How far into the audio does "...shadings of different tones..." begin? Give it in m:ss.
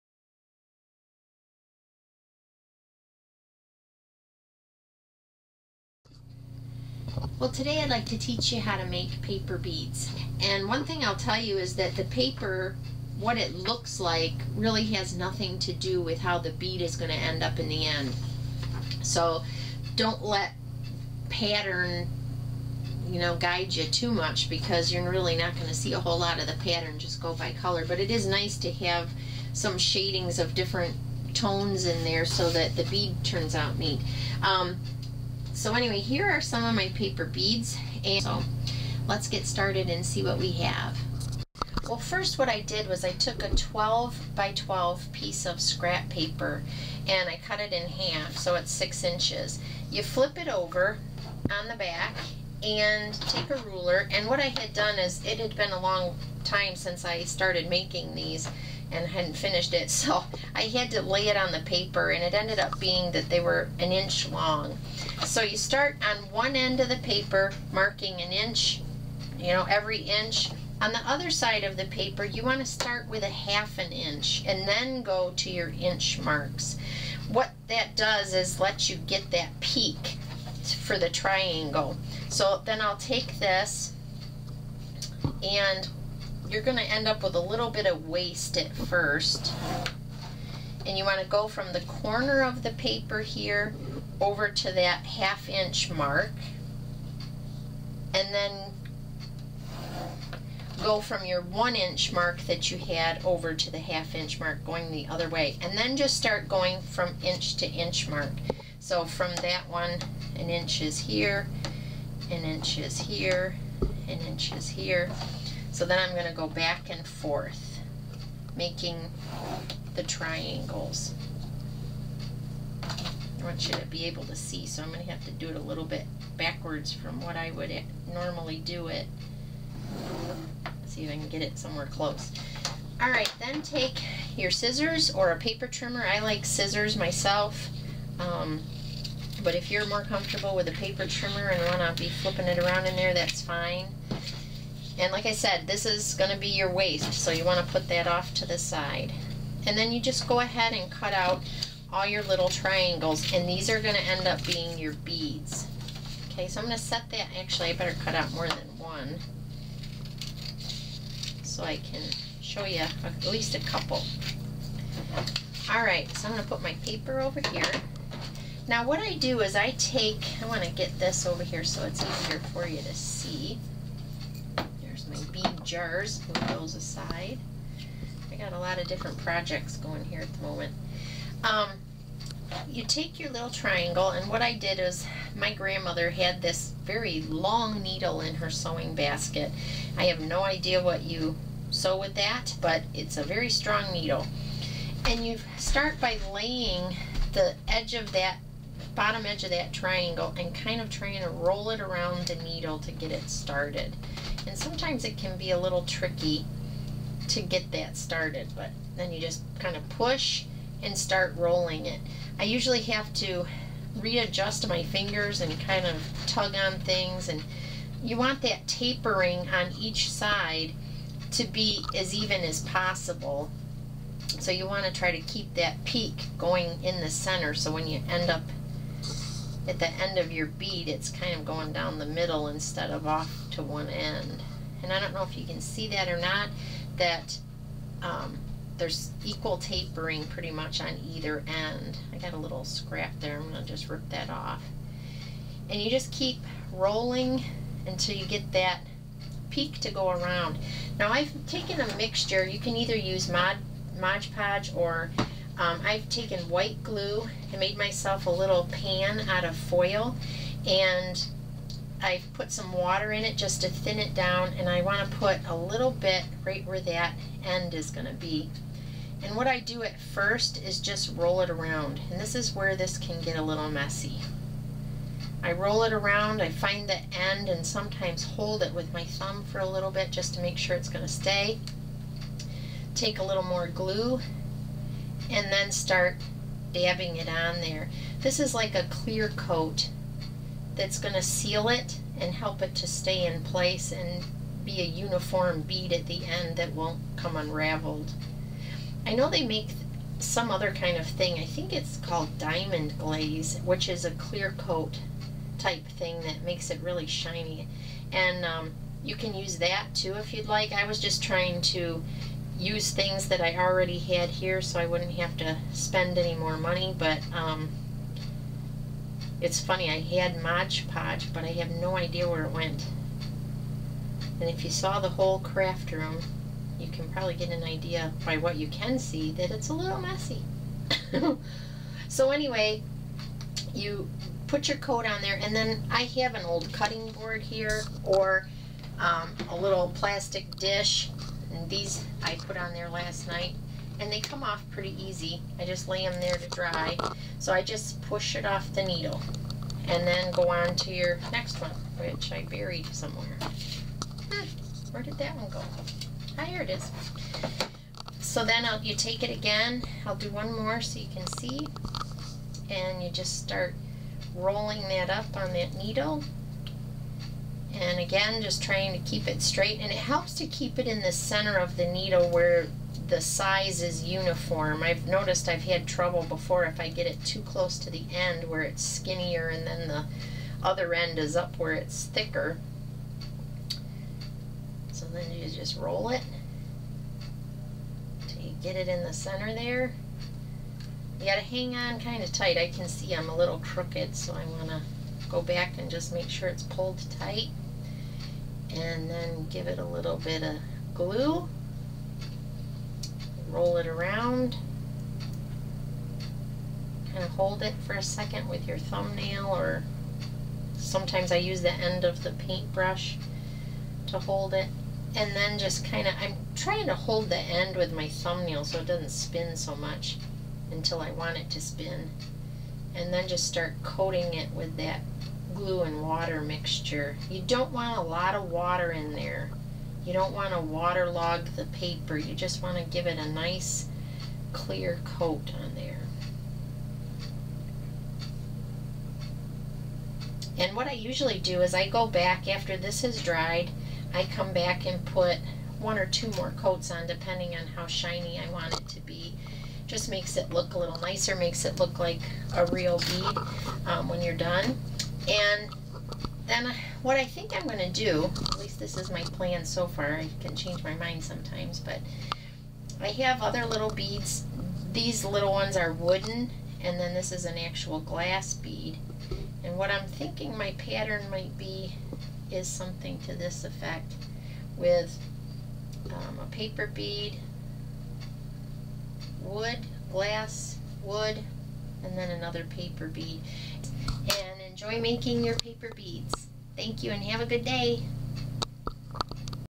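0:29.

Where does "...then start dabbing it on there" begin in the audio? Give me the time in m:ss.
4:45.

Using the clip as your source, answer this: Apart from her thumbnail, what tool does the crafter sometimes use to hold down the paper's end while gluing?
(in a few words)
paintbrush.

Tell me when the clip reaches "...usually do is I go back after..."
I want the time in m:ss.
7:20.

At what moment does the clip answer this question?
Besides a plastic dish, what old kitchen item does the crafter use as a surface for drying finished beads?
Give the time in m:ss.
5:36.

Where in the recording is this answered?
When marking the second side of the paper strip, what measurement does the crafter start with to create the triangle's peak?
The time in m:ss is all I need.
1:13.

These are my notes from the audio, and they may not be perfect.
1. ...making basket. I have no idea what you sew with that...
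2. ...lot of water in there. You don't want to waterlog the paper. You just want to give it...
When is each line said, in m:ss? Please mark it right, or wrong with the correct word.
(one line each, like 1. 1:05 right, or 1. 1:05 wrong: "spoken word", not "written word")
1. 3:08 wrong: "sewing", not "making"
2. 7:08 right.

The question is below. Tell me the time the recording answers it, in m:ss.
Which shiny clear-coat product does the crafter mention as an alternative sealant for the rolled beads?
5:02.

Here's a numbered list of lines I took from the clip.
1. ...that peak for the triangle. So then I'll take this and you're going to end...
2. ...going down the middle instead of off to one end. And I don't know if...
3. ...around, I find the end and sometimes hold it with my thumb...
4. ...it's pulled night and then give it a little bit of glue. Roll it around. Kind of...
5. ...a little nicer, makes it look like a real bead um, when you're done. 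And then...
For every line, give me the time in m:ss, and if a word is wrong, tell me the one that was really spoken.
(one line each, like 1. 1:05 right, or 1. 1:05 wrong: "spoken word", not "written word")
1. 1:19 right
2. 3:51 right
3. 4:35 right
4. 6:36 wrong: "tight", not "night"
5. 7:30 right.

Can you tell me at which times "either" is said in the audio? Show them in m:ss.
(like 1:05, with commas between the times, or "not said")
4:01, 4:12.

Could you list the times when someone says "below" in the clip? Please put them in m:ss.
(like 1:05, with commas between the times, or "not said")
not said.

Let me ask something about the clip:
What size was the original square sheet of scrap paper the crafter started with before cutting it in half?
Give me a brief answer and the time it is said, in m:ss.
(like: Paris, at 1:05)
12 by 12, at 0:43.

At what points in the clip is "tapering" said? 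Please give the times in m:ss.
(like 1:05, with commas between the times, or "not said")
3:38, 3:59.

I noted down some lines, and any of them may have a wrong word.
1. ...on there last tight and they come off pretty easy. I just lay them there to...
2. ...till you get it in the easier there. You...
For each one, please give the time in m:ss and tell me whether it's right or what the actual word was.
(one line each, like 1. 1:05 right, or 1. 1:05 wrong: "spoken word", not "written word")
1. 5:42 wrong: "night", not "tight"
2. 6:28 wrong: "center", not "easier".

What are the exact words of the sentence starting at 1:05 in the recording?
So you start on one end of the paper marking an inch, you know, every inch.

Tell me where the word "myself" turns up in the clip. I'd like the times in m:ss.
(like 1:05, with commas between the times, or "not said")
2:16, 4:17.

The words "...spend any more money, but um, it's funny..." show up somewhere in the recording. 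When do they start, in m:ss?
5:15.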